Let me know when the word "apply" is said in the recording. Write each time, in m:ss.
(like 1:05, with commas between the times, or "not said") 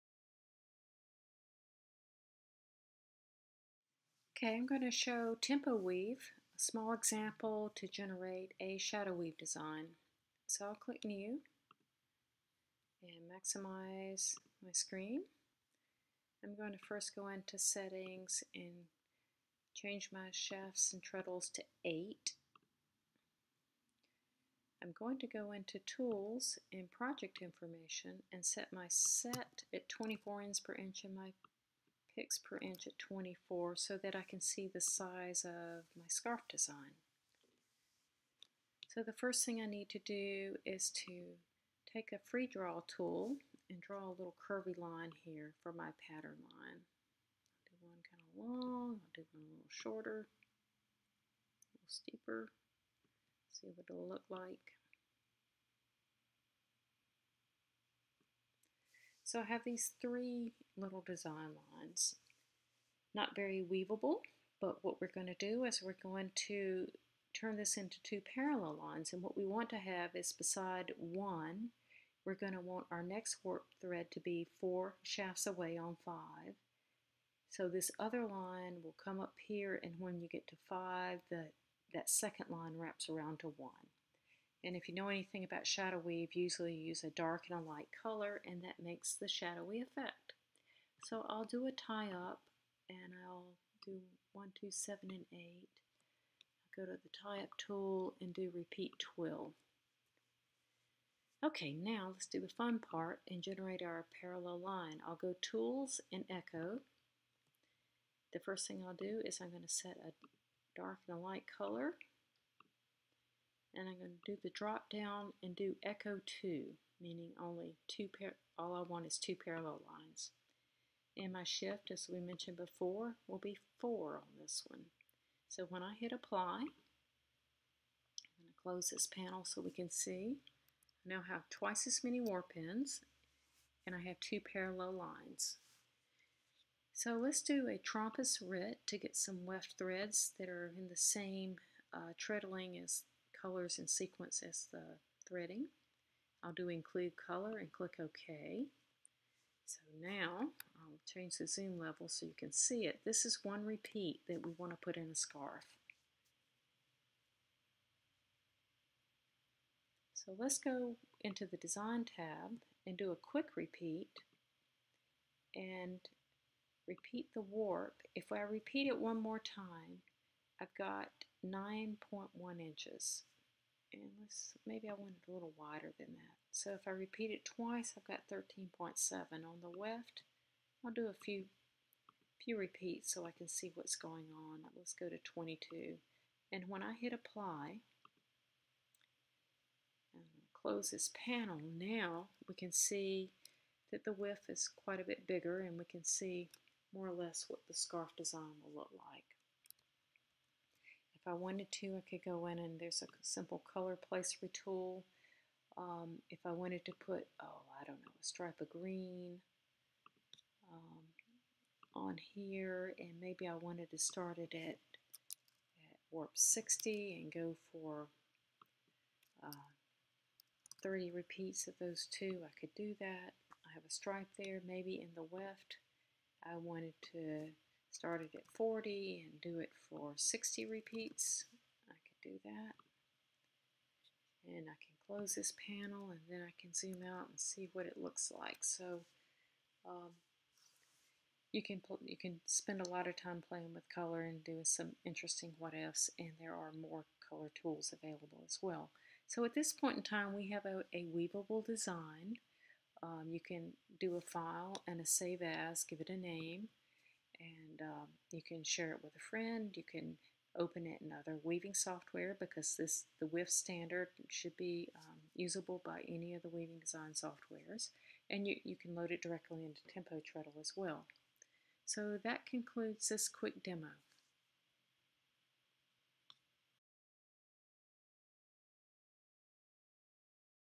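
2:06, 3:07.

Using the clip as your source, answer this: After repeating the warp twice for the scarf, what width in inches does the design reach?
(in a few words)
13.7 inches.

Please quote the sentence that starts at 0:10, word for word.
So I'll click new and maximize my screen.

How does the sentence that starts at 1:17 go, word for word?
So this other line will come up here, and when you get to five, the, that second line wraps around to one.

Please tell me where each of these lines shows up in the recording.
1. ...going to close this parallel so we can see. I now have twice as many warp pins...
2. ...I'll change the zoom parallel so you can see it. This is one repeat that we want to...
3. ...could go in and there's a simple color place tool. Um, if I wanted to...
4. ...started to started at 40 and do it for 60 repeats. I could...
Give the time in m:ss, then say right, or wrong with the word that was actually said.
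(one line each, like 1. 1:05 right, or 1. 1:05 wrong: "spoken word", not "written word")
1. 2:08 wrong: "panel", not "parallel"
2. 2:30 wrong: "level", not "parallel"
3. 3:22 right
4. 3:46 wrong: "wanted", not "started".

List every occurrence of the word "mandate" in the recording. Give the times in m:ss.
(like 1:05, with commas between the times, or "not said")
not said.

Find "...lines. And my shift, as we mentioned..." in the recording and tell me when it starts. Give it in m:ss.
1:59.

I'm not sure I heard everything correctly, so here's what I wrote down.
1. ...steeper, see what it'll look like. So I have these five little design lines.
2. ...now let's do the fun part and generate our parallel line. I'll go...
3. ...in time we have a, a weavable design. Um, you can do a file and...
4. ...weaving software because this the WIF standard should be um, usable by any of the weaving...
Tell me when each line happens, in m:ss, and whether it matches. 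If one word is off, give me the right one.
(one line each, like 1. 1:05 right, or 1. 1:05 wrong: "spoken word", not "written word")
1. 0:51 wrong: "three", not "five"
2. 1:41 right
3. 4:09 right
4. 4:21 right.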